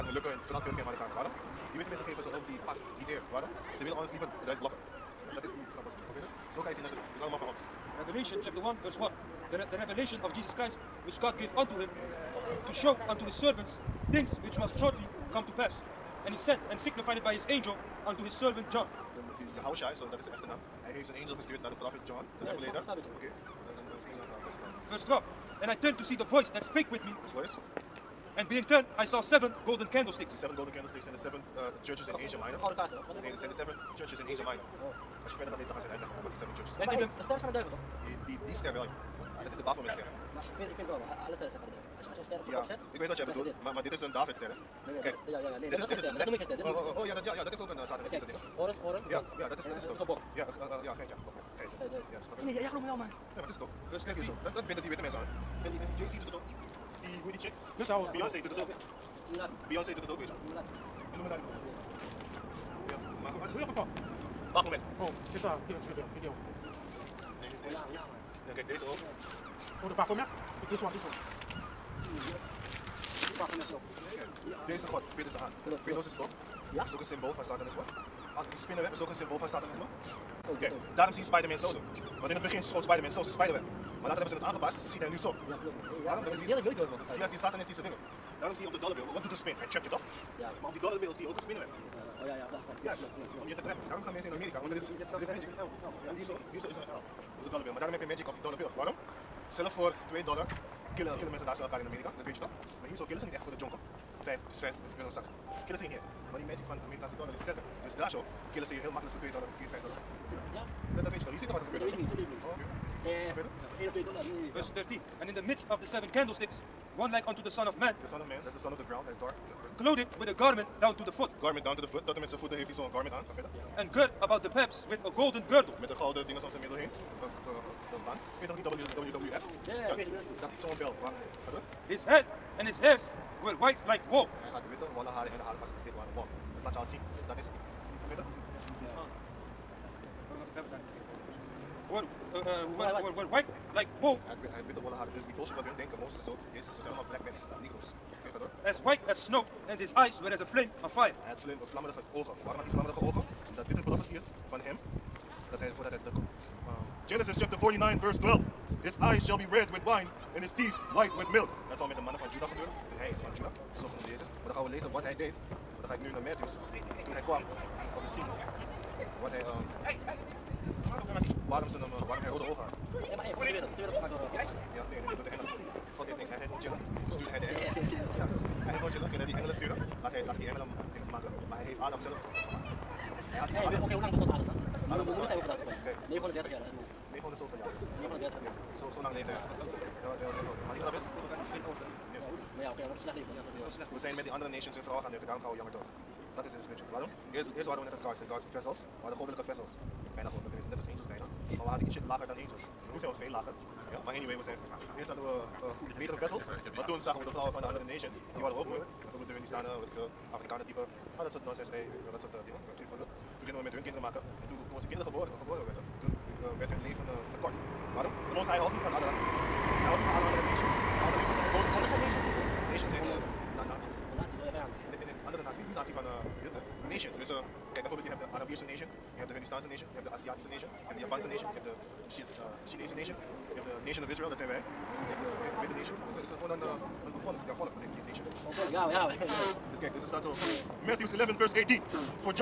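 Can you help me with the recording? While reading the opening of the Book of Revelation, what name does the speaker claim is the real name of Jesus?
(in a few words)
Hawashai.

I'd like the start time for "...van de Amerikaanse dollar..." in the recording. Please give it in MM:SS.
01:46.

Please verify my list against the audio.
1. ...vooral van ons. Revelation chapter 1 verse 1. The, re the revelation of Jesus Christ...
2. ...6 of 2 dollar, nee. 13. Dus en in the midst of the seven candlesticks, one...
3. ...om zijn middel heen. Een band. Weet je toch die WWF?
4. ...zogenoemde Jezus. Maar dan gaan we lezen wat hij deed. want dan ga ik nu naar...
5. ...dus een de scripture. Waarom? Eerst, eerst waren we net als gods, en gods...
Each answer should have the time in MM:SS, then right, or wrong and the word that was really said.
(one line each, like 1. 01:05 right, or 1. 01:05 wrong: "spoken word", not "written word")
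1. 00:07 wrong: "allemaal", not "vooral"
2. 01:53 wrong: "1", not "6"
3. 02:06 right
4. 02:43 right
5. 03:16 right.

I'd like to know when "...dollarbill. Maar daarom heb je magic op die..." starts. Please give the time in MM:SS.
01:37.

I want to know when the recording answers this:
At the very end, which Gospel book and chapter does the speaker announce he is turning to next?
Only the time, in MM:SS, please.
04:00.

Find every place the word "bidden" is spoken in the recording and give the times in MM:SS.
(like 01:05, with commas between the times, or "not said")
00:54, 01:15.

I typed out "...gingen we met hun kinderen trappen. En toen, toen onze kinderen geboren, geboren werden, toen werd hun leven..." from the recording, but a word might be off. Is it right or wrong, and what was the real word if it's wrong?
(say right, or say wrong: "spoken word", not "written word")
wrong: "maken", not "trappen".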